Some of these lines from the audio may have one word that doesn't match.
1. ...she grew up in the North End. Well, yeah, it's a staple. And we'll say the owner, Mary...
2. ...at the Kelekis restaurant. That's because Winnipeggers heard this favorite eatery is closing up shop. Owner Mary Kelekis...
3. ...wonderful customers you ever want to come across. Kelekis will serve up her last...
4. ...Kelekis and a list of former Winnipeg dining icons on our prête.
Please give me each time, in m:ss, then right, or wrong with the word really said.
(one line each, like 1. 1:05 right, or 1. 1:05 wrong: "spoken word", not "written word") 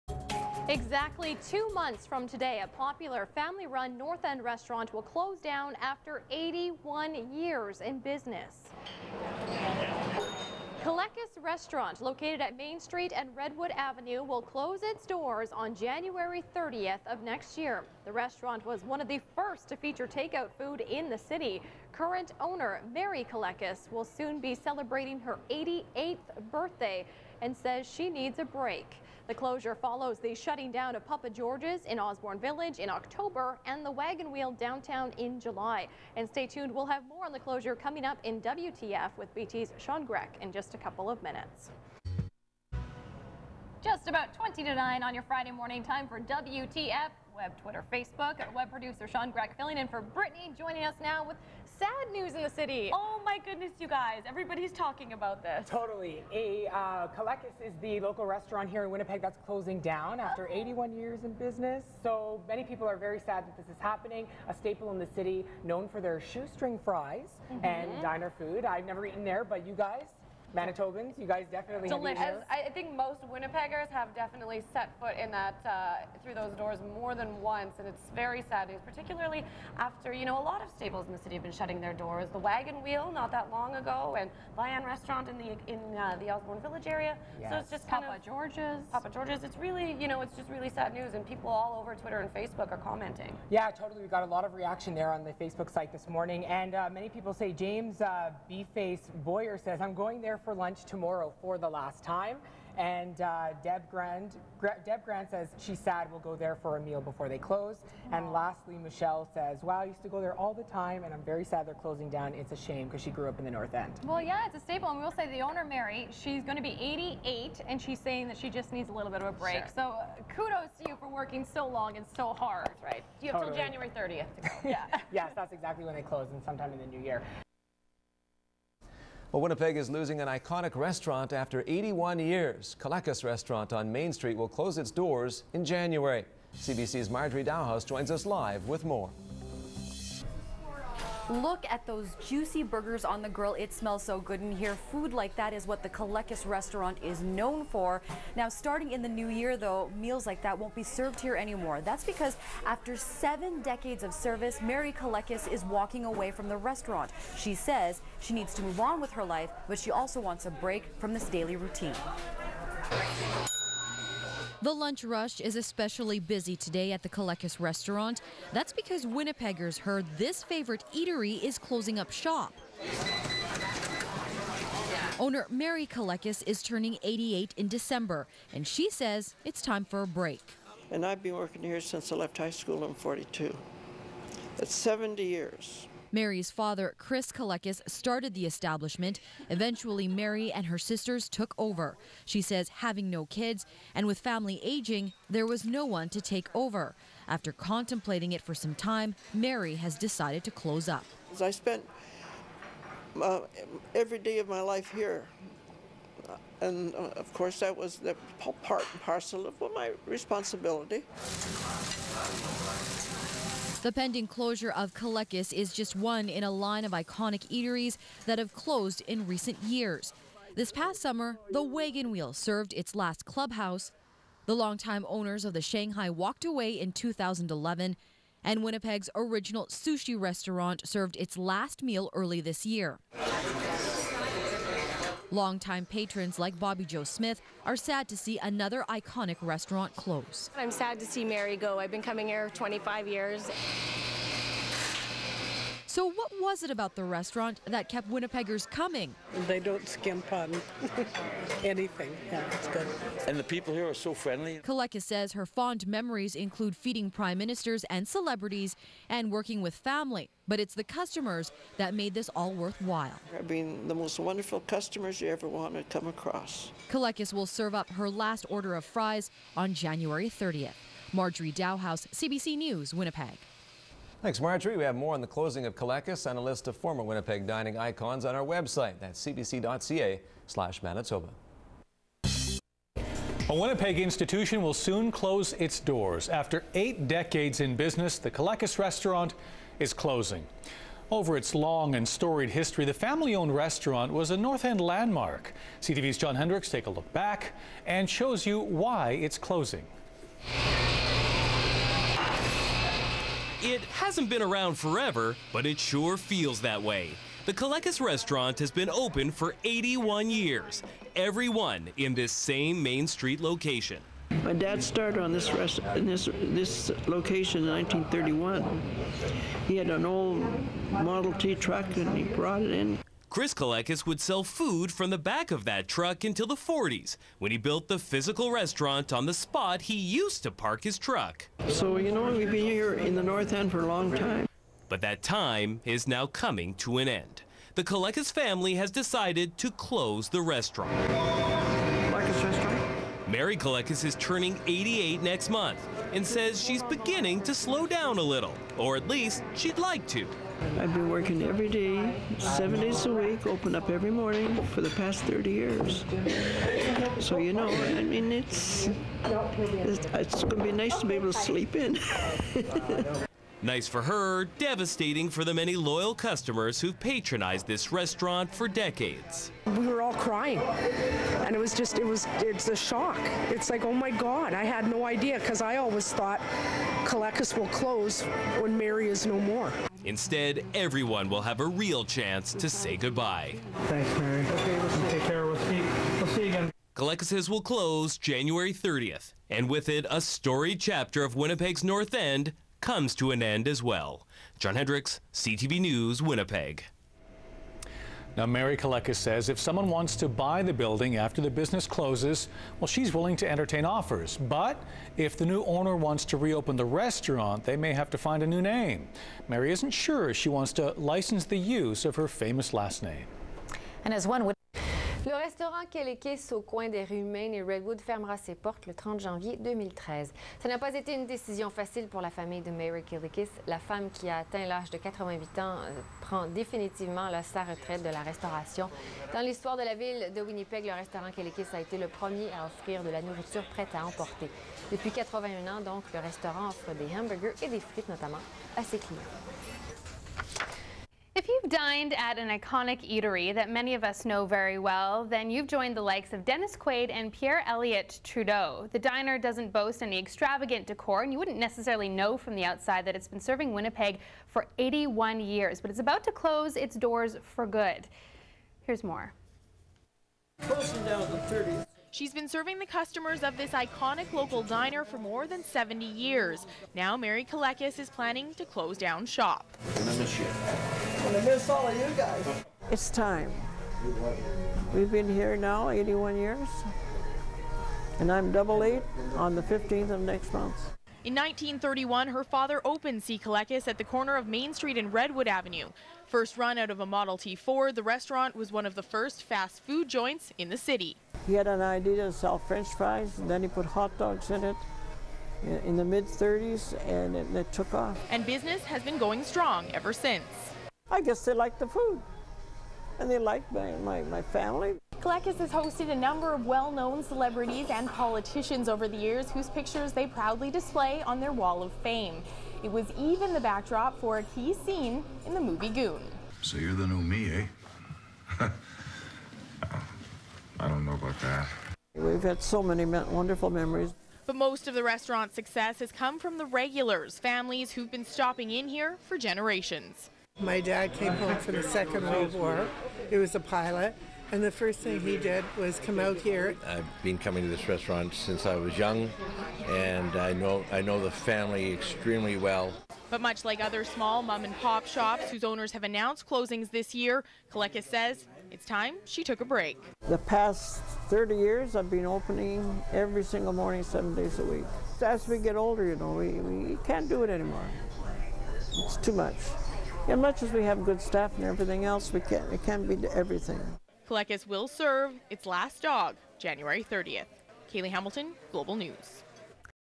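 1. 1:53 right
2. 2:46 right
3. 4:24 right
4. 4:35 wrong: "website", not "prête".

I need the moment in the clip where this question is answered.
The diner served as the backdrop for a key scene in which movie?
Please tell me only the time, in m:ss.
8:35.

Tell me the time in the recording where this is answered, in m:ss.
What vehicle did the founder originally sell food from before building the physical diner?
5:20.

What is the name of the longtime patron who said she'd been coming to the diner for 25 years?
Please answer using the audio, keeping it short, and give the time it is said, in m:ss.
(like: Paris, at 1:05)
Bobby Joe Smith, at 3:56.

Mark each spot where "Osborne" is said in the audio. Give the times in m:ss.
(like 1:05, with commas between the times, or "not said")
0:31, 1:26.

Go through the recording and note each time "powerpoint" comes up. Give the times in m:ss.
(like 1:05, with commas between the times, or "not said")
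not said.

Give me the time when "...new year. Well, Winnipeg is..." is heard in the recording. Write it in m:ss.
2:06.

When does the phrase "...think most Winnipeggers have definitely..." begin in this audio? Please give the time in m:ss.
1:12.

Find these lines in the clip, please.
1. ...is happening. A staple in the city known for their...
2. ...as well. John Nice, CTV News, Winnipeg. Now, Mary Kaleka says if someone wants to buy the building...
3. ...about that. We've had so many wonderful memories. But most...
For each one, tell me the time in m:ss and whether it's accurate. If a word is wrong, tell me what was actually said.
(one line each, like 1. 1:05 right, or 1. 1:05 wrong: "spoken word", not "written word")
1. 1:03 right
2. 6:33 wrong: "Hendricks", not "Nice"
3. 8:41 right.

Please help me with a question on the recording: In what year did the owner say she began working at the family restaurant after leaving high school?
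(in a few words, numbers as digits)
1942.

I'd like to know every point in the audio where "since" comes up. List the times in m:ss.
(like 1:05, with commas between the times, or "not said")
3:01, 8:20, 8:58.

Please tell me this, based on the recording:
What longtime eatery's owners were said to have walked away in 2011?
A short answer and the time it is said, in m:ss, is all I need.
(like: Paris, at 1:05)
the Shanghai, at 3:45.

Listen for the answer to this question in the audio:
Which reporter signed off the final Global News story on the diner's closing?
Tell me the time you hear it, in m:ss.
9:27.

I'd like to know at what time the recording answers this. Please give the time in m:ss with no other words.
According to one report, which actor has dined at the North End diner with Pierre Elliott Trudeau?
7:26.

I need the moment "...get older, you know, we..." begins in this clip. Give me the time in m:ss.
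9:15.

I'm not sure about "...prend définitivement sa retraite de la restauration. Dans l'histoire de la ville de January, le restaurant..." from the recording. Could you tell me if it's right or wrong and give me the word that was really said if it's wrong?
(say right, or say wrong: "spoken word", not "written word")
wrong: "Winnipeg", not "January".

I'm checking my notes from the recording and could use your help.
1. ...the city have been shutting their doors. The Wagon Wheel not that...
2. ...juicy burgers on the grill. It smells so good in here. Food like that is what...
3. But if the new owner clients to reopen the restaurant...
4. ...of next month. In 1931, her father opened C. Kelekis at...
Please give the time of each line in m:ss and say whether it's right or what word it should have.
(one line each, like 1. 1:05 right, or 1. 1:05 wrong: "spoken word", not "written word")
1. 1:21 right
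2. 2:22 right
3. 6:44 wrong: "wants", not "clients"
4. 8:00 right.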